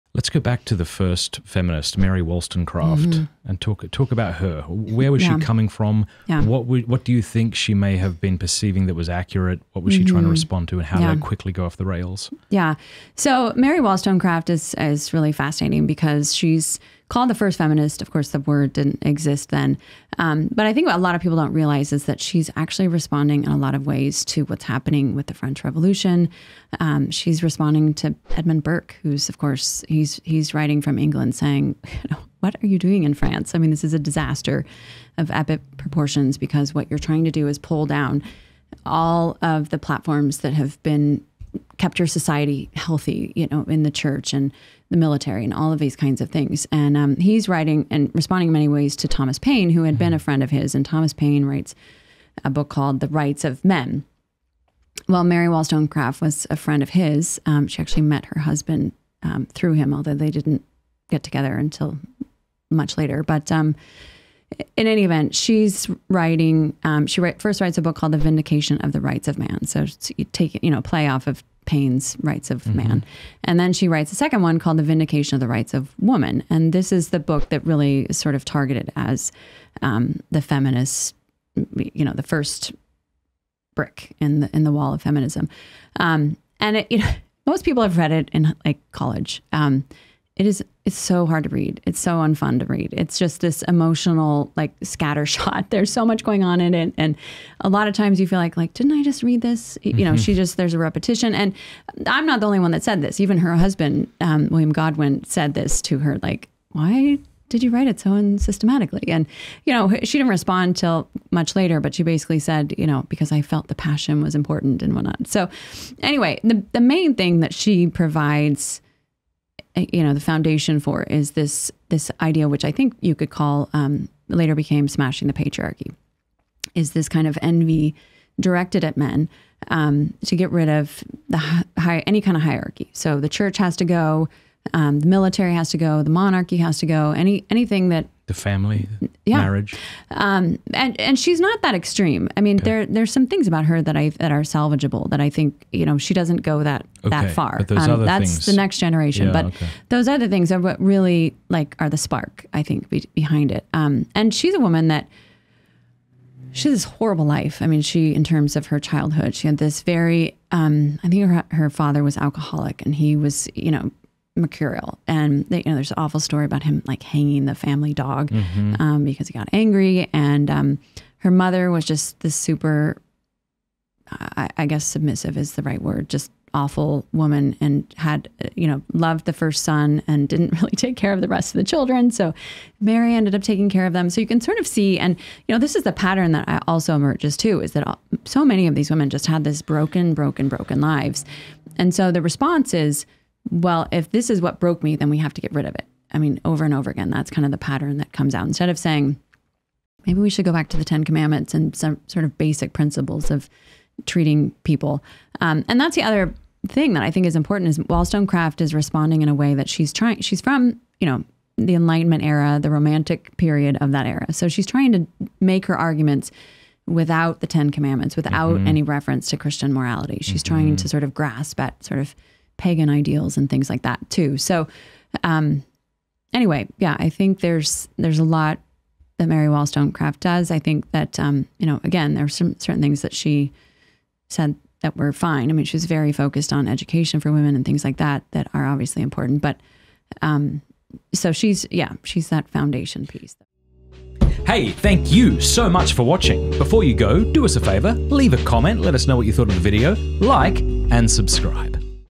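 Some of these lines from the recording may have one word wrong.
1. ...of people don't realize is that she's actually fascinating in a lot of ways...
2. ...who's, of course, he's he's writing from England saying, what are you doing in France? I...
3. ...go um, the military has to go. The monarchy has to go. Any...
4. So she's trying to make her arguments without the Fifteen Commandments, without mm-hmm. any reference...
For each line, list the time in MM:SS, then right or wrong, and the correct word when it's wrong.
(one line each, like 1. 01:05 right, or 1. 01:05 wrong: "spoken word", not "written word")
1. 00:21 wrong: "responding", not "fascinating"
2. 00:29 right
3. 02:13 right
4. 03:34 wrong: "Ten", not "Fifteen".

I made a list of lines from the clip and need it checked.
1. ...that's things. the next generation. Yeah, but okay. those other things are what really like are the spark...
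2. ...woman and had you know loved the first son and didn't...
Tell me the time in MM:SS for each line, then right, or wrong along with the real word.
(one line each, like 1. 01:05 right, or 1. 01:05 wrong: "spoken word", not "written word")
1. 02:28 right
2. 02:57 right.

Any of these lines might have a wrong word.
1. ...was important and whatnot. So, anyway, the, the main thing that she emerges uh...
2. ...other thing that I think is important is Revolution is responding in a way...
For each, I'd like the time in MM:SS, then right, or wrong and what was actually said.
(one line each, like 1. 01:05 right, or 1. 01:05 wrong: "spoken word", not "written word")
1. 01:54 wrong: "provides", not "emerges"
2. 03:26 wrong: "Wollstonecraft", not "Revolution".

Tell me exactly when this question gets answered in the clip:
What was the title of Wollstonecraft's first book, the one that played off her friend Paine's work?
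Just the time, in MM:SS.
01:08.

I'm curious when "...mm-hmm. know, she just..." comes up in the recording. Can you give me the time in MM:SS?
01:39.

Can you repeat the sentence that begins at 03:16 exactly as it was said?
I mean, over and over again, that's kind of the pattern that comes out.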